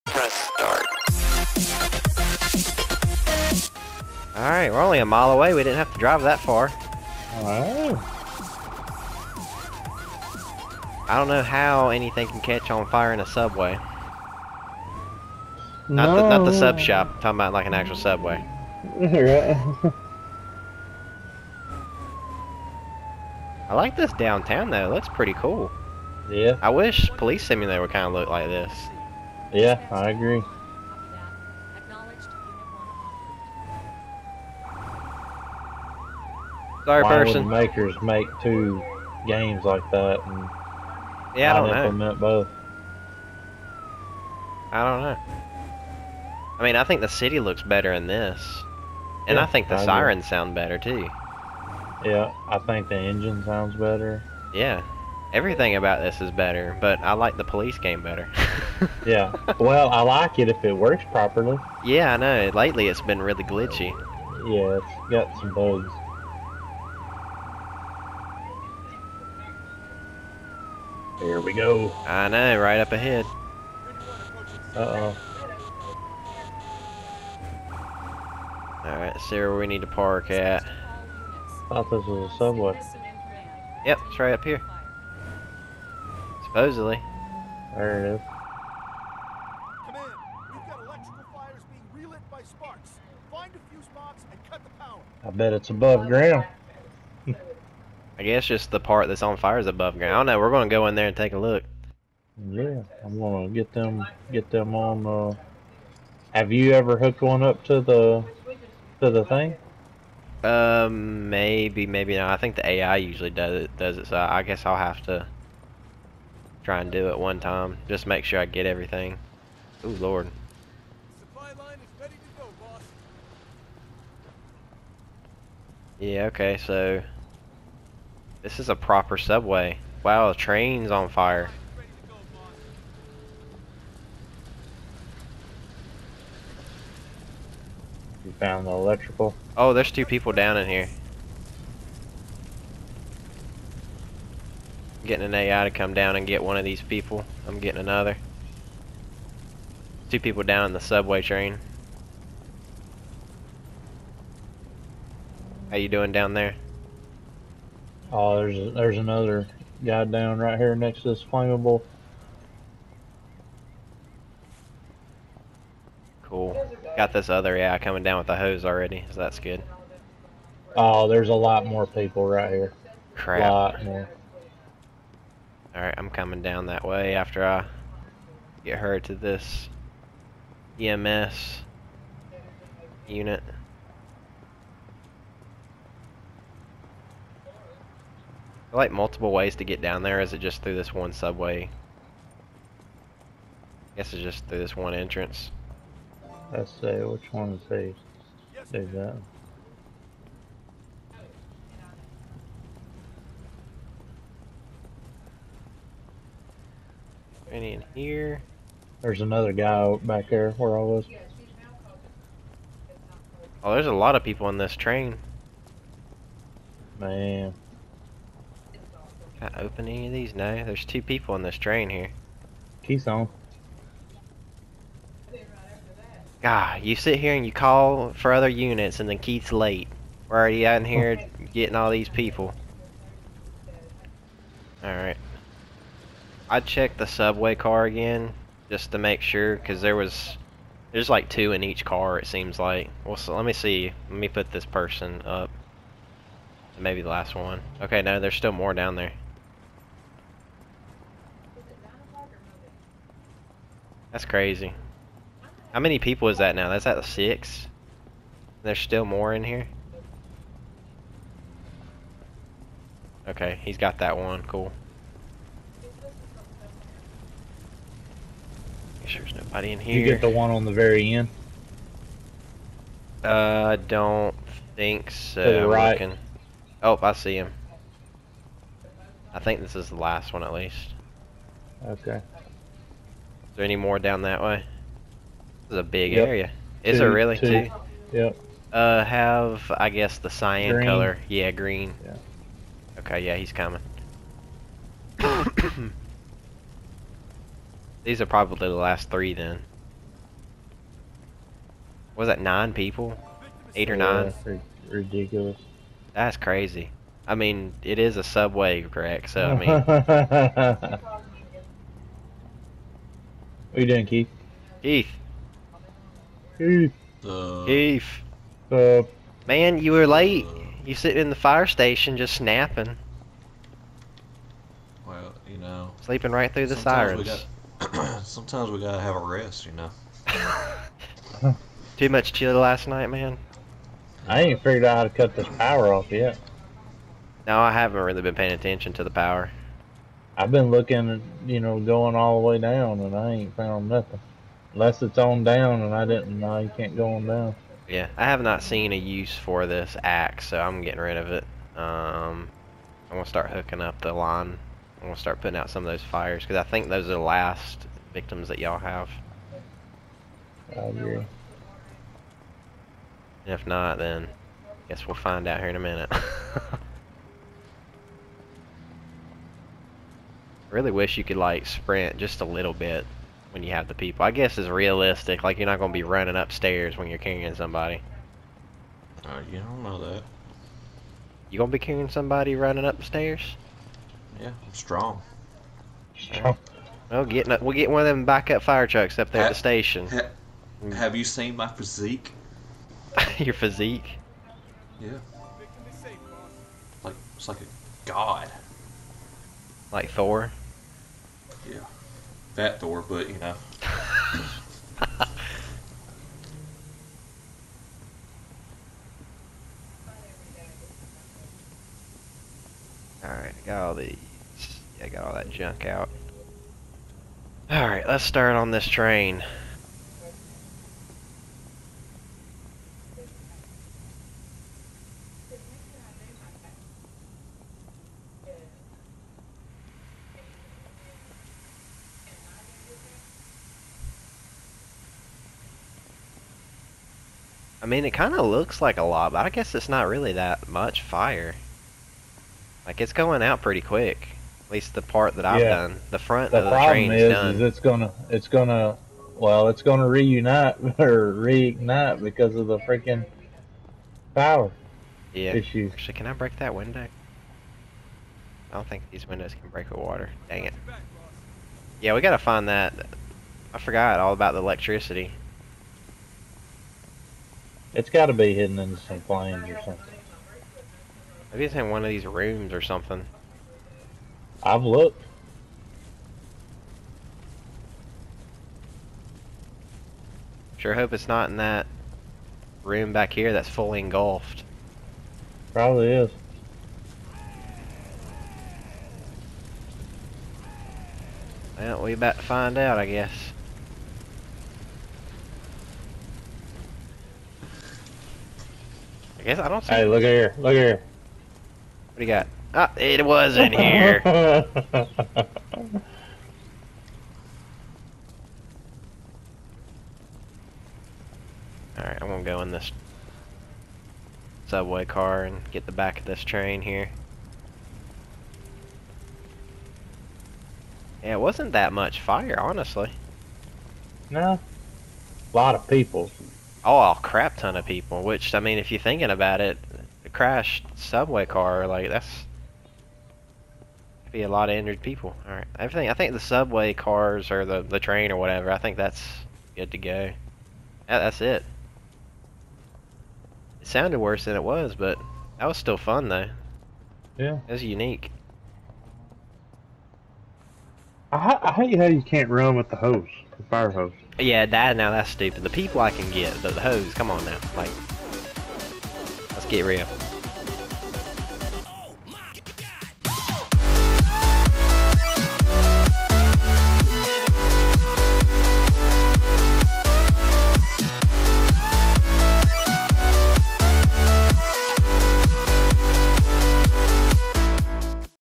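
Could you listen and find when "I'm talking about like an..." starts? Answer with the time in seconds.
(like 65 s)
17 s.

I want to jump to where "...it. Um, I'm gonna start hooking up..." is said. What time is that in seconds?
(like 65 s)
351 s.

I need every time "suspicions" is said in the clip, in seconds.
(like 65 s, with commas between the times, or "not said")
not said.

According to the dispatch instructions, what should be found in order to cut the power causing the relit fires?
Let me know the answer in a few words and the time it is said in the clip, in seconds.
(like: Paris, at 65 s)
fuse box, at 93 s.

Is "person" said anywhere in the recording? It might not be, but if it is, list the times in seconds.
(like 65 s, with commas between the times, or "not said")
37 s, 244 s.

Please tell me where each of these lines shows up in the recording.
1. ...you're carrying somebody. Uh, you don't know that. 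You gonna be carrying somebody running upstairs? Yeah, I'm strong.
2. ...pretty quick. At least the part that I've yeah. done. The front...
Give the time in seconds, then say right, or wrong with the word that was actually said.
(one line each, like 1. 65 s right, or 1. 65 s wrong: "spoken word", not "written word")
1. 377 s right
2. 443 s right.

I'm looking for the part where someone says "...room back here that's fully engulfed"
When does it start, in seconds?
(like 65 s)
482 s.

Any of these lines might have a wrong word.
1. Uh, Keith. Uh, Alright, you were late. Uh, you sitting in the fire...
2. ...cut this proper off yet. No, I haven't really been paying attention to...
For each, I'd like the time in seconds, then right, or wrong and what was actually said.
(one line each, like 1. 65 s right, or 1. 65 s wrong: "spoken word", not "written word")
1. 317 s wrong: "Man", not "Alright"
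2. 335 s wrong: "power", not "proper".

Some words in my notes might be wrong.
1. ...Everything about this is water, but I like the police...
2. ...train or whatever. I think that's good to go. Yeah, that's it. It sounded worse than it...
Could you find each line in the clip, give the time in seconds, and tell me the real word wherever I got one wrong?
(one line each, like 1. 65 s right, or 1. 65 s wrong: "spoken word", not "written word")
1. 55 s wrong: "better", not "water"
2. 537 s right.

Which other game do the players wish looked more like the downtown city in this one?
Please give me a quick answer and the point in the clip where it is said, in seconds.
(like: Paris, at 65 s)
Police Simulator, at 27 s.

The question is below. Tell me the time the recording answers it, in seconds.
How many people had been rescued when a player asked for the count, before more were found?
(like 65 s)
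257 s.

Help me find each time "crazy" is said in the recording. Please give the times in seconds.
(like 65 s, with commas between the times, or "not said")
254 s, 306 s.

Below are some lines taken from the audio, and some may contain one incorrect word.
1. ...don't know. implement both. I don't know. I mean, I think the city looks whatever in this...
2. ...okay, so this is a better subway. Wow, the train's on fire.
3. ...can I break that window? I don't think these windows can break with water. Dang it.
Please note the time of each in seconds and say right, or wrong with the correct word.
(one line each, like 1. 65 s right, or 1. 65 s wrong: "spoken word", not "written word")
1. 41 s wrong: "better", not "whatever"
2. 126 s wrong: "proper", not "better"
3. 456 s right.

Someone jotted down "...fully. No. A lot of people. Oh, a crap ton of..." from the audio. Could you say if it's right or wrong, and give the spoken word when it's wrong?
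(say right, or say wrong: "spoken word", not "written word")
wrong: "honestly", not "fully".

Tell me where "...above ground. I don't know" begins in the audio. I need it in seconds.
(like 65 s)
99 s.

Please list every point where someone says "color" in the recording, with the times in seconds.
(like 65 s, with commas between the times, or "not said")
290 s.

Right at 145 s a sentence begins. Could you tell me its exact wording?
getting an AI to come down and get one of these people.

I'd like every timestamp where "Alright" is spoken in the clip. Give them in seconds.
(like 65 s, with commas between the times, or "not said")
4 s, 78 s, 175 s, 234 s, 417 s, 504 s.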